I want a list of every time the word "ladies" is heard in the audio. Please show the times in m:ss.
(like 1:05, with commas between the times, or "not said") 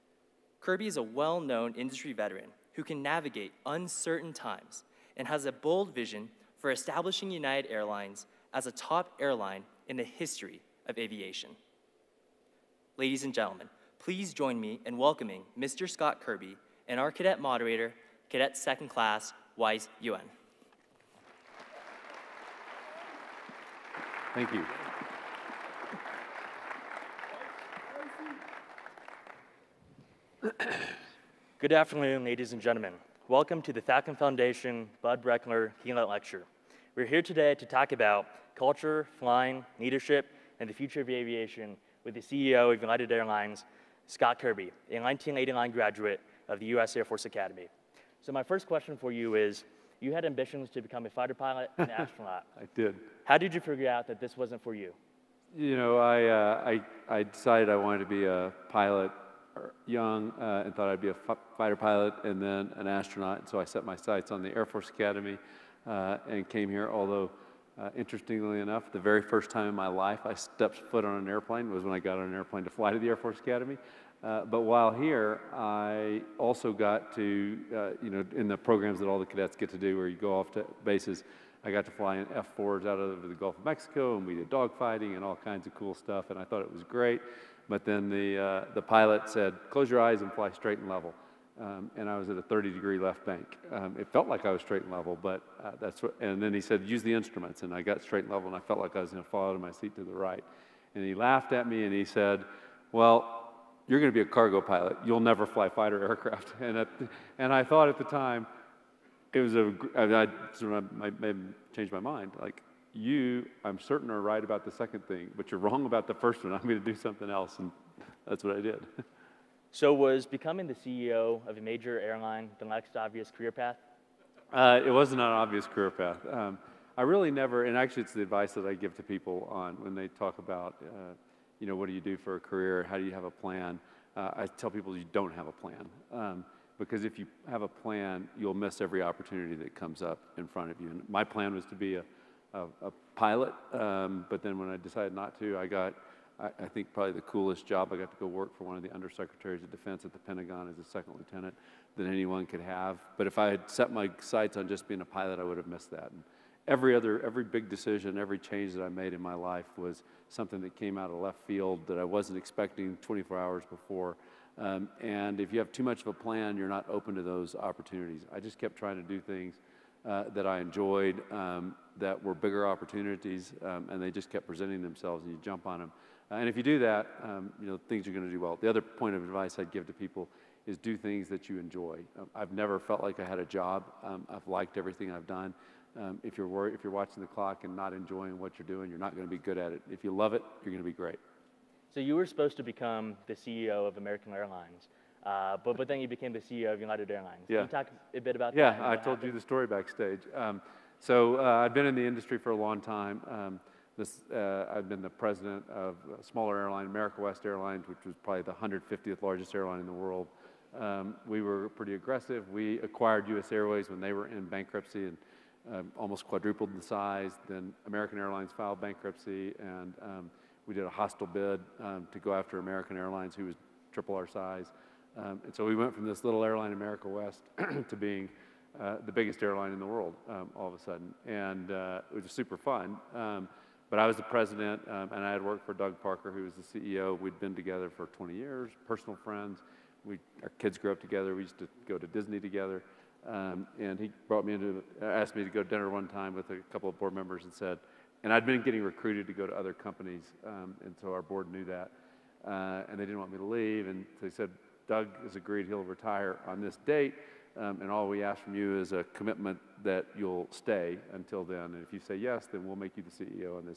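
0:12, 0:32.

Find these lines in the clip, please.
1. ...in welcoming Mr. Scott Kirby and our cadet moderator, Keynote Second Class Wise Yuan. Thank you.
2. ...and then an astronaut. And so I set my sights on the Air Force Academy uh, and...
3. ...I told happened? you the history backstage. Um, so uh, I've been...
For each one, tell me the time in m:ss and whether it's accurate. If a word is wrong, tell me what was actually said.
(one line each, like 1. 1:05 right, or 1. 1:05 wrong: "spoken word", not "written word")
1. 0:14 wrong: "Cadet", not "Keynote"
2. 1:02 right
3. 3:18 wrong: "story", not "history".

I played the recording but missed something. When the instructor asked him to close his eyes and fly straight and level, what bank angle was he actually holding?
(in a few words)
30 degree left bank.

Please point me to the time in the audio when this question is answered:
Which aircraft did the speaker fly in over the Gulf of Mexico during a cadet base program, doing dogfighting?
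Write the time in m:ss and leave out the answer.
1:22.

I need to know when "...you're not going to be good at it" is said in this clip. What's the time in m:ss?
3:08.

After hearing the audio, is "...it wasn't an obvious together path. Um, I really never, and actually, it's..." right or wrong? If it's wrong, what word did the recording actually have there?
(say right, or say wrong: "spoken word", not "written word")
wrong: "career", not "together".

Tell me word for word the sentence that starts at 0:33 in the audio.
Welcome to the Falcon Foundation Bud Breckner Keynote Lecture.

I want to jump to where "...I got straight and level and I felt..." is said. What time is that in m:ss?
1:37.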